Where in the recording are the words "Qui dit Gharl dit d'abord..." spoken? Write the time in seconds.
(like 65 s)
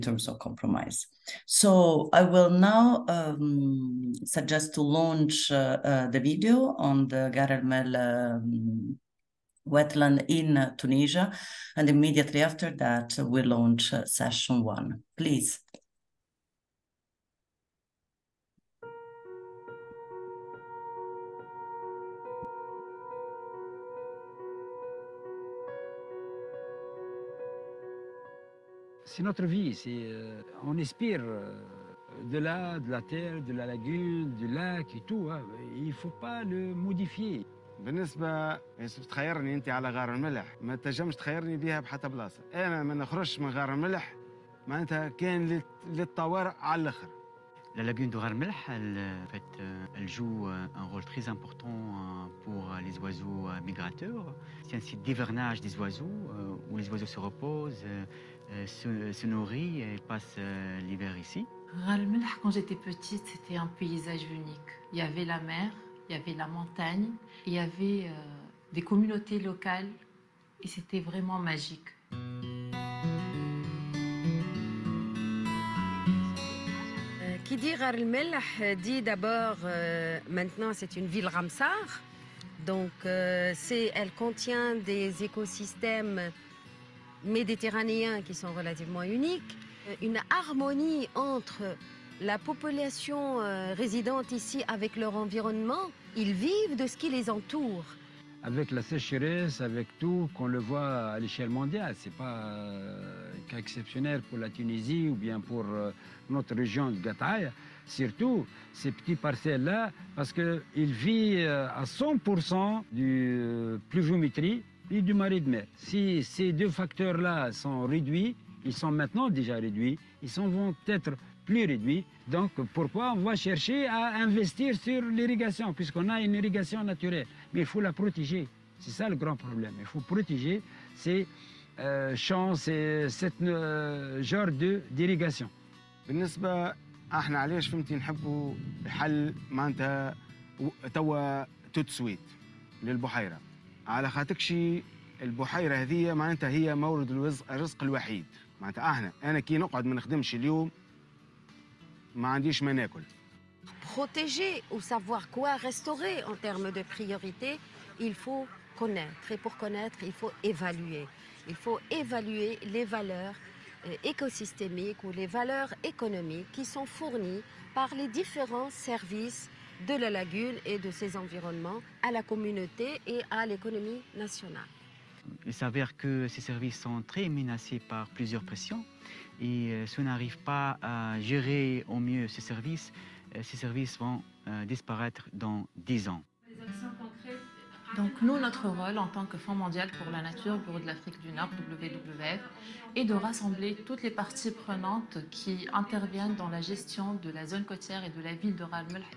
77 s.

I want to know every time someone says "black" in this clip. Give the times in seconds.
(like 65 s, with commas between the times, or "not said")
not said.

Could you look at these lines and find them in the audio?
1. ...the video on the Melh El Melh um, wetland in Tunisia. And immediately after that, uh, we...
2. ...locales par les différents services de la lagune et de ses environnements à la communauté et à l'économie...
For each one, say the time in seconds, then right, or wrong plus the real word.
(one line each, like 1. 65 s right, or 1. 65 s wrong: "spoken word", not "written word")
1. 6 s wrong: "Ghar", not "Melh"
2. 166 s wrong: "fournies", not "locales".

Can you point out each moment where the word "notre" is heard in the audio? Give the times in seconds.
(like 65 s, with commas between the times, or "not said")
29 s, 106 s, 188 s.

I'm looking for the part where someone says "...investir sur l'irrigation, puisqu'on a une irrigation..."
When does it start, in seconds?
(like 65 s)
124 s.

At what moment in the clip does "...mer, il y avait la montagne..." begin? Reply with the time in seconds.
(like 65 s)
65 s.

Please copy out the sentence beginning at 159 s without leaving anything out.
Et pour connaître, il faut évaluer.